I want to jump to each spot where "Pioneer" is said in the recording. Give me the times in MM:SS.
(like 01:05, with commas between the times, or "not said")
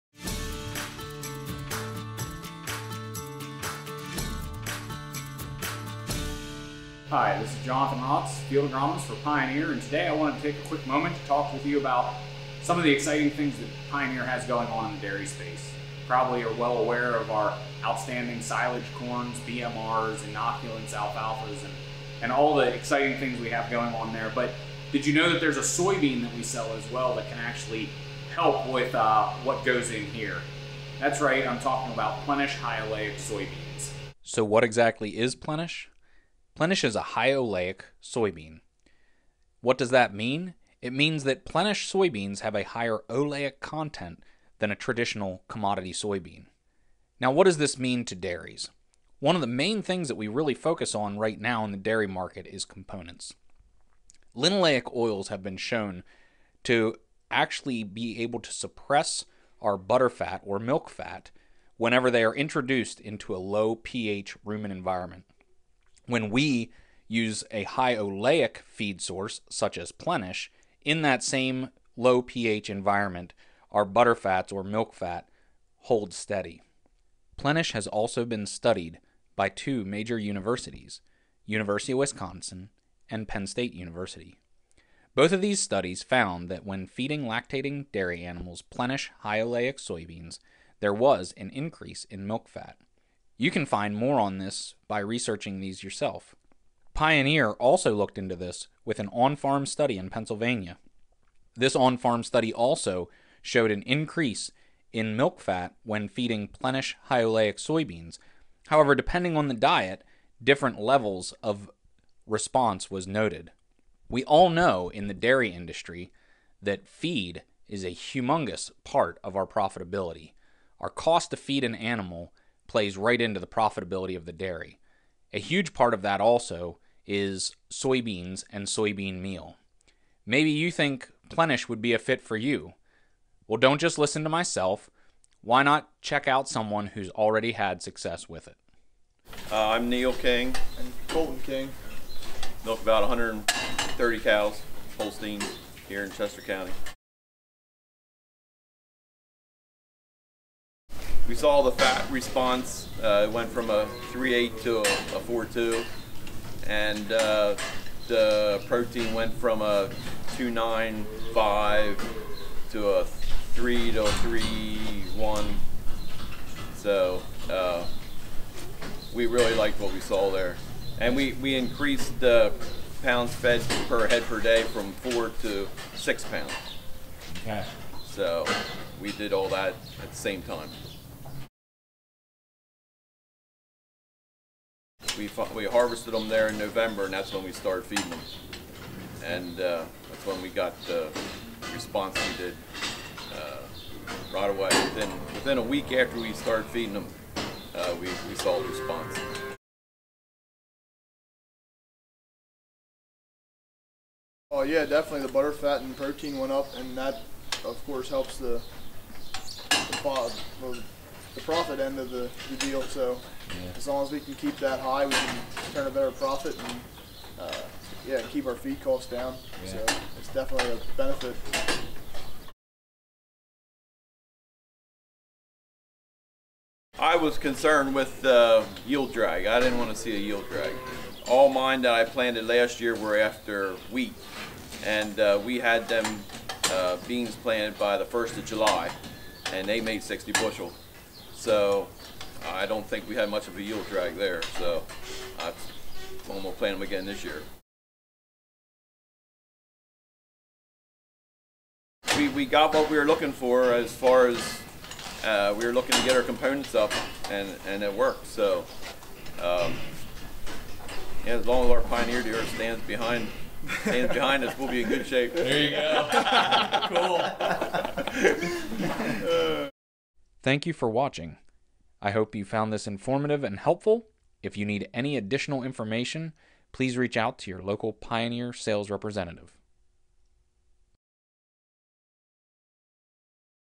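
00:09, 00:13, 01:36, 04:21, 04:37.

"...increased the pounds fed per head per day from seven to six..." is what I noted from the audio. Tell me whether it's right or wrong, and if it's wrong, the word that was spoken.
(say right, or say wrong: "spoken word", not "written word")
wrong: "four", not "seven".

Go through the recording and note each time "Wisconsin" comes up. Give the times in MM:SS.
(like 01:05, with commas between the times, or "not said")
01:21.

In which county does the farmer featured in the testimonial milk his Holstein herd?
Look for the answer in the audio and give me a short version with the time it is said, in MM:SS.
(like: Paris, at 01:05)
Chester County, at 02:26.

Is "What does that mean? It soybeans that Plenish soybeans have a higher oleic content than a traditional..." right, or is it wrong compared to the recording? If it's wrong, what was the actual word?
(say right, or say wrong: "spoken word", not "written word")
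wrong: "means", not "soybeans".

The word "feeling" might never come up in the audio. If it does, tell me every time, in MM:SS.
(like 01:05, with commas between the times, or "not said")
not said.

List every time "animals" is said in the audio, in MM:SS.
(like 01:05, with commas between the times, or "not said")
01:28, 02:01.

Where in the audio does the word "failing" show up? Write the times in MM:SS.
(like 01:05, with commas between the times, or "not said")
not said.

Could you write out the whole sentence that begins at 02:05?
A huge part of that also is soybeans and soybean meal.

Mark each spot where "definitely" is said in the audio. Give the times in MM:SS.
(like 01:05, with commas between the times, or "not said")
03:24, 03:40.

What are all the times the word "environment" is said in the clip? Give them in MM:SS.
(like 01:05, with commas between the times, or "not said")
01:04, 01:12.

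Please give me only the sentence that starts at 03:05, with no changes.
we we harvested them there in November, and that's when we started feeding them.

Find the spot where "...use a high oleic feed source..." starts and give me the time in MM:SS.
01:07.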